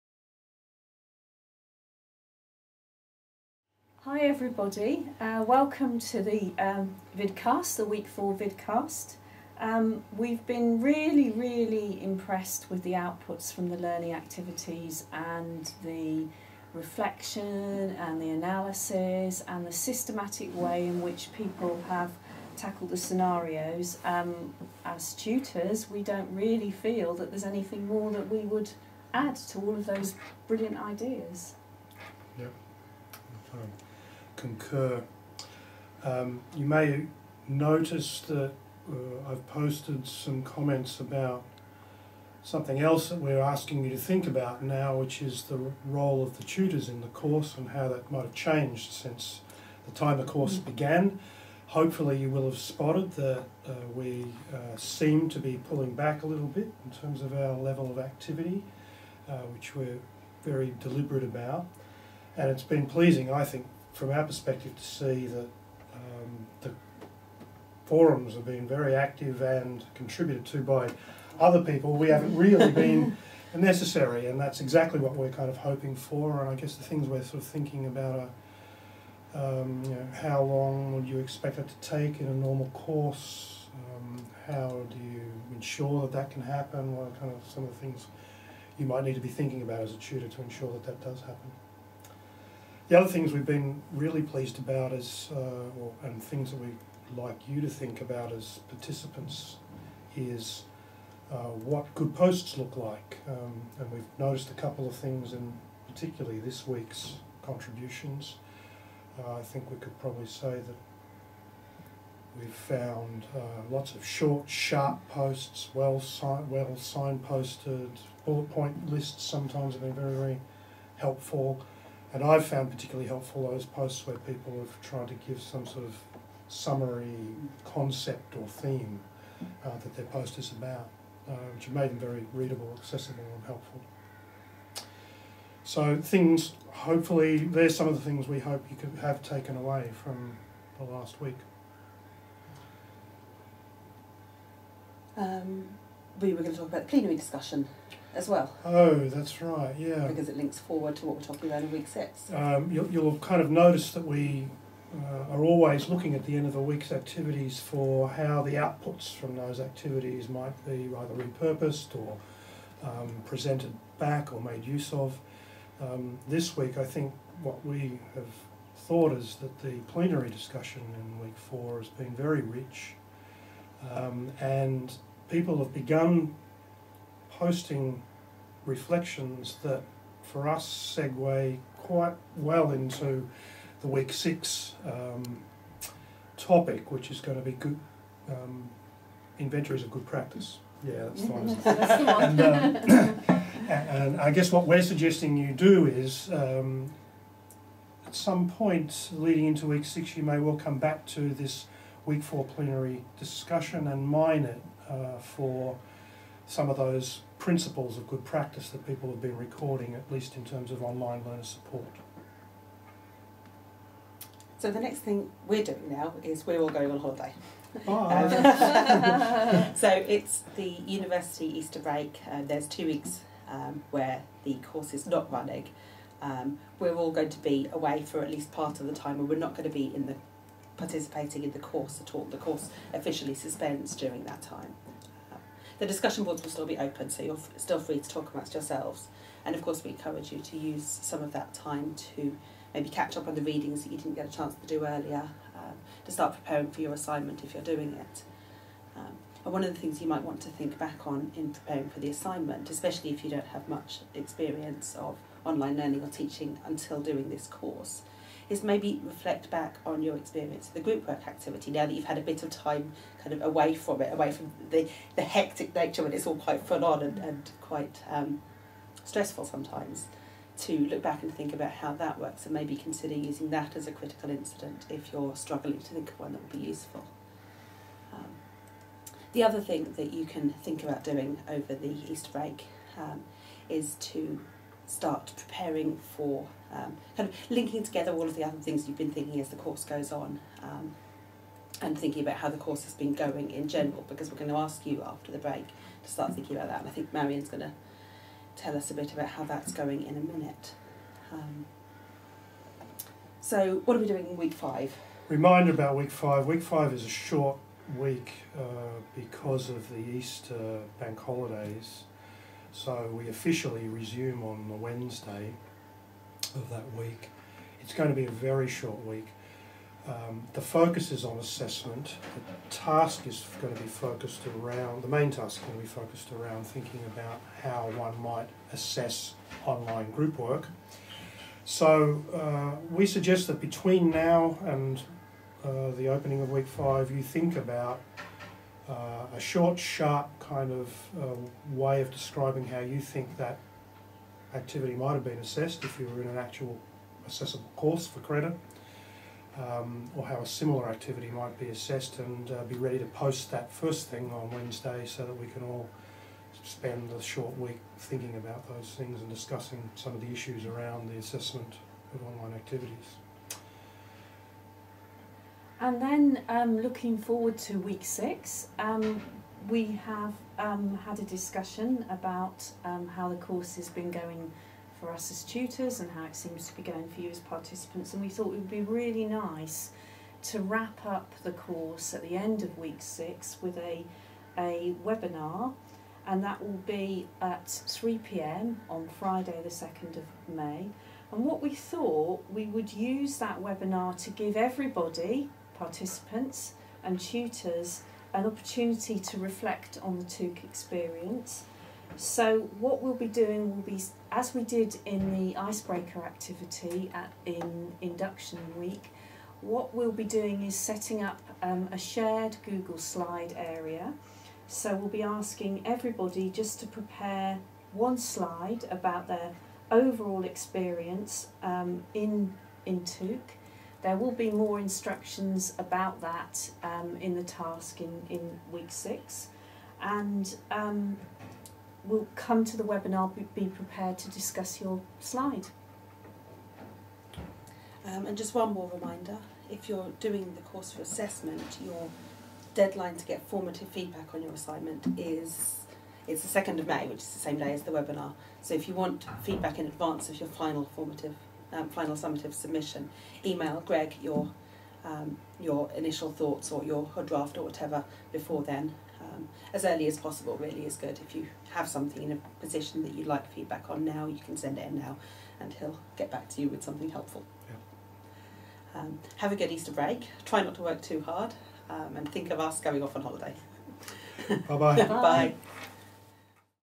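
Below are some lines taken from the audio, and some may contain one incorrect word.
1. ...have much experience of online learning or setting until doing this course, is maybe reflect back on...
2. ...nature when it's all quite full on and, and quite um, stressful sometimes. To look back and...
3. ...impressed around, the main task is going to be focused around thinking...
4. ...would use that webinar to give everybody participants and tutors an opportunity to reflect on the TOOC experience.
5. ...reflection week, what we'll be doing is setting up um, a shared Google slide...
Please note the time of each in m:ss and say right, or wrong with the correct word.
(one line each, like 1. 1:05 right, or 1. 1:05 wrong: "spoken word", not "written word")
1. 4:13 wrong: "teaching", not "setting"
2. 4:25 right
3. 5:23 wrong: "focused", not "impressed"
4. 6:32 right
5. 6:47 wrong: "induction", not "reflection".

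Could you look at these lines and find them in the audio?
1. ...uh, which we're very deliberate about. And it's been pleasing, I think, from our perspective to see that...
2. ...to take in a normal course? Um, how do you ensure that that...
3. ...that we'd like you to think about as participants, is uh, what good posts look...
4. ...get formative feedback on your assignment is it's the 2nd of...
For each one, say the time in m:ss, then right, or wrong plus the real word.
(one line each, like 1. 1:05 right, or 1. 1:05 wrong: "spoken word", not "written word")
1. 0:59 right
2. 1:21 right
3. 1:36 right
4. 7:23 right.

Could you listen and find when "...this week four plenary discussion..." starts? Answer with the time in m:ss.
3:21.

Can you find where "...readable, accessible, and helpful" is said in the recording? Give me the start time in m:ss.
2:12.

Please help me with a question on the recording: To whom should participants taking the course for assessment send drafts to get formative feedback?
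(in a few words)
Greg.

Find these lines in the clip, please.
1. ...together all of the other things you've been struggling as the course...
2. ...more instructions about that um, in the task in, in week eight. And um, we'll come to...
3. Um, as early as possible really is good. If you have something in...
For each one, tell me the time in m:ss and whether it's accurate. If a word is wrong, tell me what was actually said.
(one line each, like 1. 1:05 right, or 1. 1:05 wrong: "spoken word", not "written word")
1. 4:47 wrong: "thinking", not "struggling"
2. 7:04 wrong: "six", not "eight"
3. 7:39 right.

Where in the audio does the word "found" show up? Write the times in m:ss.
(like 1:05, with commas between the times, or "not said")
1:52, 2:02.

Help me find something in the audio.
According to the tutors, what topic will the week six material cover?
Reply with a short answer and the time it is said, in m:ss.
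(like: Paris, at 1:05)
inventories of good practice, at 3:09.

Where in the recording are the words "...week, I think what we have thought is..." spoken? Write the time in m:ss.
2:46.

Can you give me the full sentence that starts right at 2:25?
Um, we were going to talk about the plenary discussion as well.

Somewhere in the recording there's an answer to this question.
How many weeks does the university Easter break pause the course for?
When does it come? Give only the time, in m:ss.
3:42.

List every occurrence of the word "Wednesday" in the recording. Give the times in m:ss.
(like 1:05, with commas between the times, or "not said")
5:14, 5:54.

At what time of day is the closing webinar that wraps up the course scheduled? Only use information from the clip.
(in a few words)
3pm.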